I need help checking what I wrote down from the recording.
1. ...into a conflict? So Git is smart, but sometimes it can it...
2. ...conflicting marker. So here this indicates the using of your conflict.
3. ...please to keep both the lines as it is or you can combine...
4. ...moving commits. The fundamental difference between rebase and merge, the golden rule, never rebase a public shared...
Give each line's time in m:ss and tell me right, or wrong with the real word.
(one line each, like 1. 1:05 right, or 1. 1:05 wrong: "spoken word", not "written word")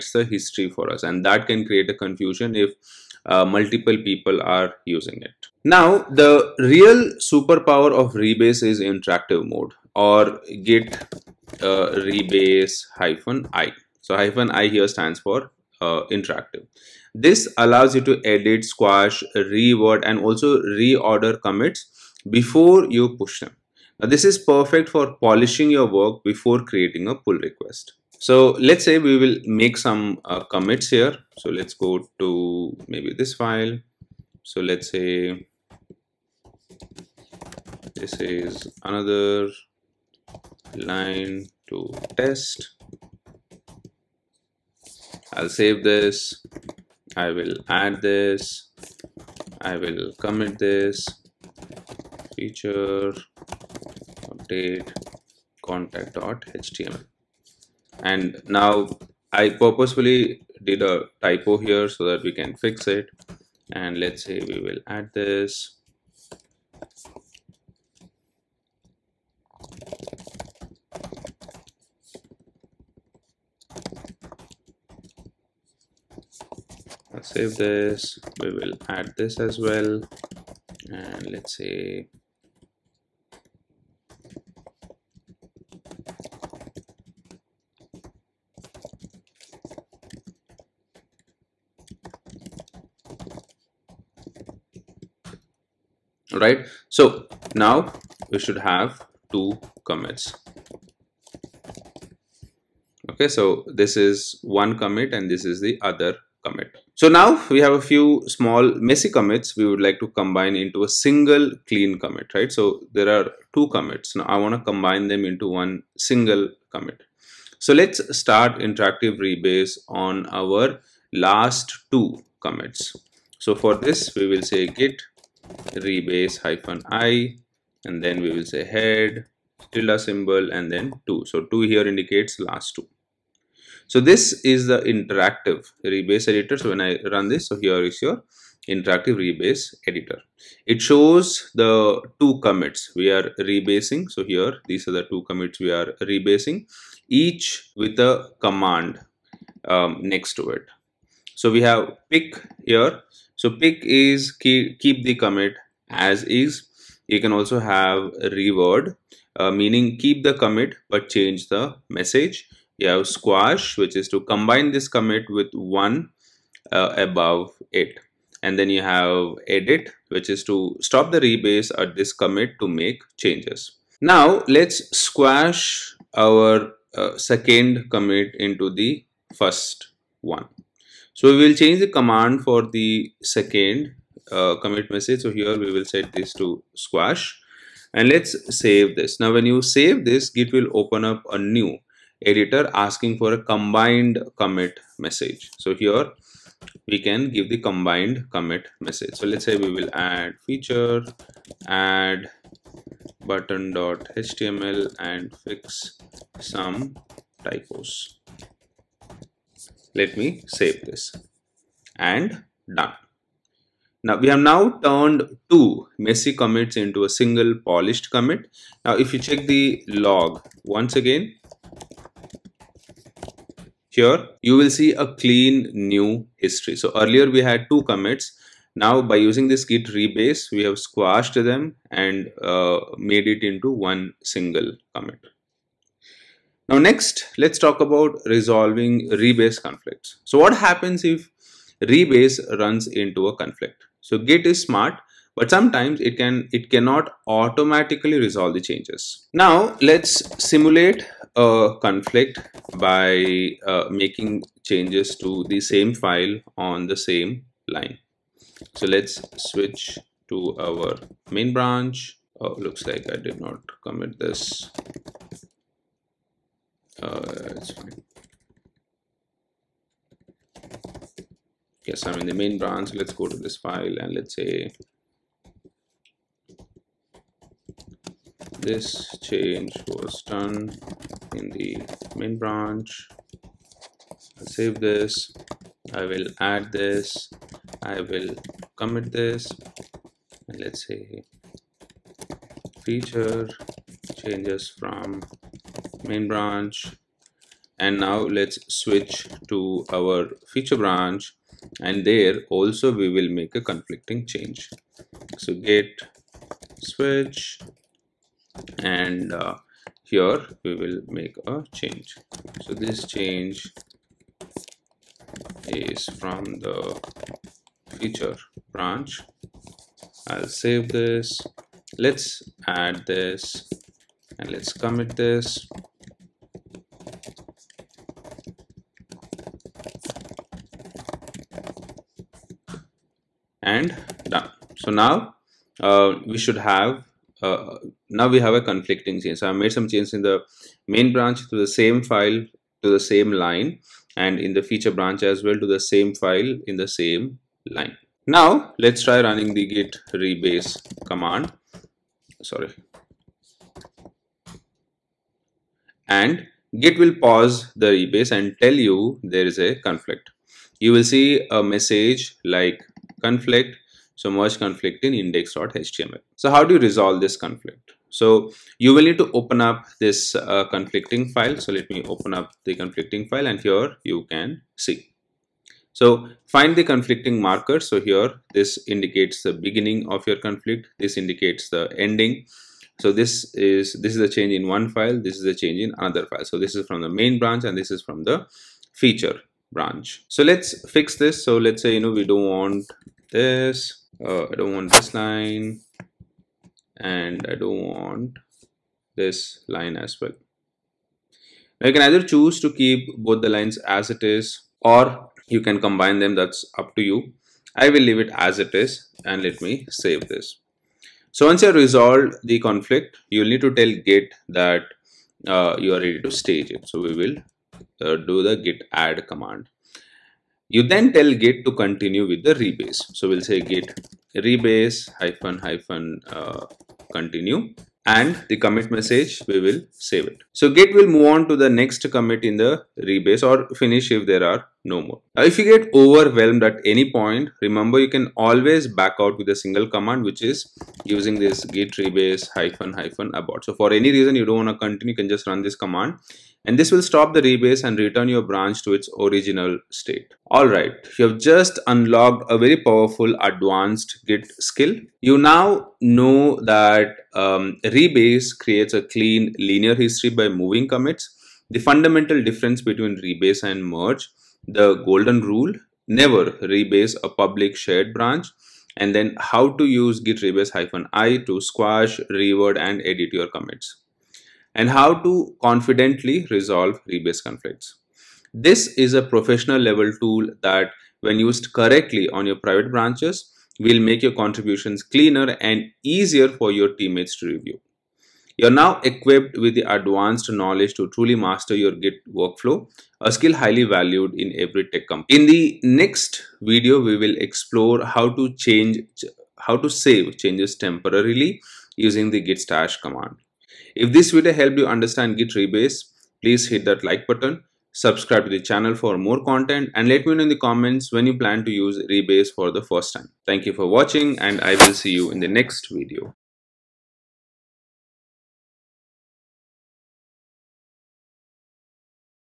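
1. 4:02 right
2. 6:16 wrong: "beginning", not "using"
3. 6:42 wrong: "choose", not "please"
4. 7:40 right.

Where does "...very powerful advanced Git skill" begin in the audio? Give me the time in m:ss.
7:32.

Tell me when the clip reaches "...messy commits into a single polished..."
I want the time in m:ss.
3:35.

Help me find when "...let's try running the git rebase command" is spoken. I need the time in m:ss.
5:48.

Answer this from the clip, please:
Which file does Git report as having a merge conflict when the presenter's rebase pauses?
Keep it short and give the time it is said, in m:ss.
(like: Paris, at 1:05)
index.html, at 6:05.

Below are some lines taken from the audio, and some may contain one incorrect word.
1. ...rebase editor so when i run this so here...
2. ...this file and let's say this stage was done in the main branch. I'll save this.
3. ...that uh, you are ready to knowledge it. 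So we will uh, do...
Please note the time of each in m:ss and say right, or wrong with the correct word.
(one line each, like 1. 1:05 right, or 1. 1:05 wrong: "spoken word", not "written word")
1. 2:15 right
2. 4:33 wrong: "change", not "stage"
3. 6:54 wrong: "stage", not "knowledge".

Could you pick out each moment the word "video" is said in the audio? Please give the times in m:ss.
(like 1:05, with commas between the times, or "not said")
8:16, 8:24, 8:35.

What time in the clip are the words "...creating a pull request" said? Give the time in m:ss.
0:26.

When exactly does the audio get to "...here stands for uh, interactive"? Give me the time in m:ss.
0:14.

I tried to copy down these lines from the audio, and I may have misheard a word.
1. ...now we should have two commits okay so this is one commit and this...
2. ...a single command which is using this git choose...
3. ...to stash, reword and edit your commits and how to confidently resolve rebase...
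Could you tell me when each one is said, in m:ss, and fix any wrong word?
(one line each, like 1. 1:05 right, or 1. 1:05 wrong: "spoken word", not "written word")
1. 1:37 right
2. 7:19 wrong: "rebase", not "choose"
3. 7:51 wrong: "squash", not "stash".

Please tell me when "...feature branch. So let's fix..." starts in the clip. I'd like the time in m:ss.
6:28.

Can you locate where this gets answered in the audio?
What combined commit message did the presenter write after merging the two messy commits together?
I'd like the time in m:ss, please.
3:20.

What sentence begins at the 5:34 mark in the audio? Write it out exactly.
So now uh, we should have, uh, now we have a conflicting change.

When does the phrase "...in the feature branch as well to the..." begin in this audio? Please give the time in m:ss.
5:44.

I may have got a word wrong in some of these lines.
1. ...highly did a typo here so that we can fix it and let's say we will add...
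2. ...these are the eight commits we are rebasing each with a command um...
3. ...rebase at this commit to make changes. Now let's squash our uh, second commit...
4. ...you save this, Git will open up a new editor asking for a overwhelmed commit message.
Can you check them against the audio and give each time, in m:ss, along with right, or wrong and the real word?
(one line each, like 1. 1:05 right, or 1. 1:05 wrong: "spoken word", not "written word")
1. 0:59 wrong: "purposefully", not "highly"
2. 2:24 wrong: "two", not "eight"
3. 2:51 right
4. 3:09 wrong: "combined", not "overwhelmed".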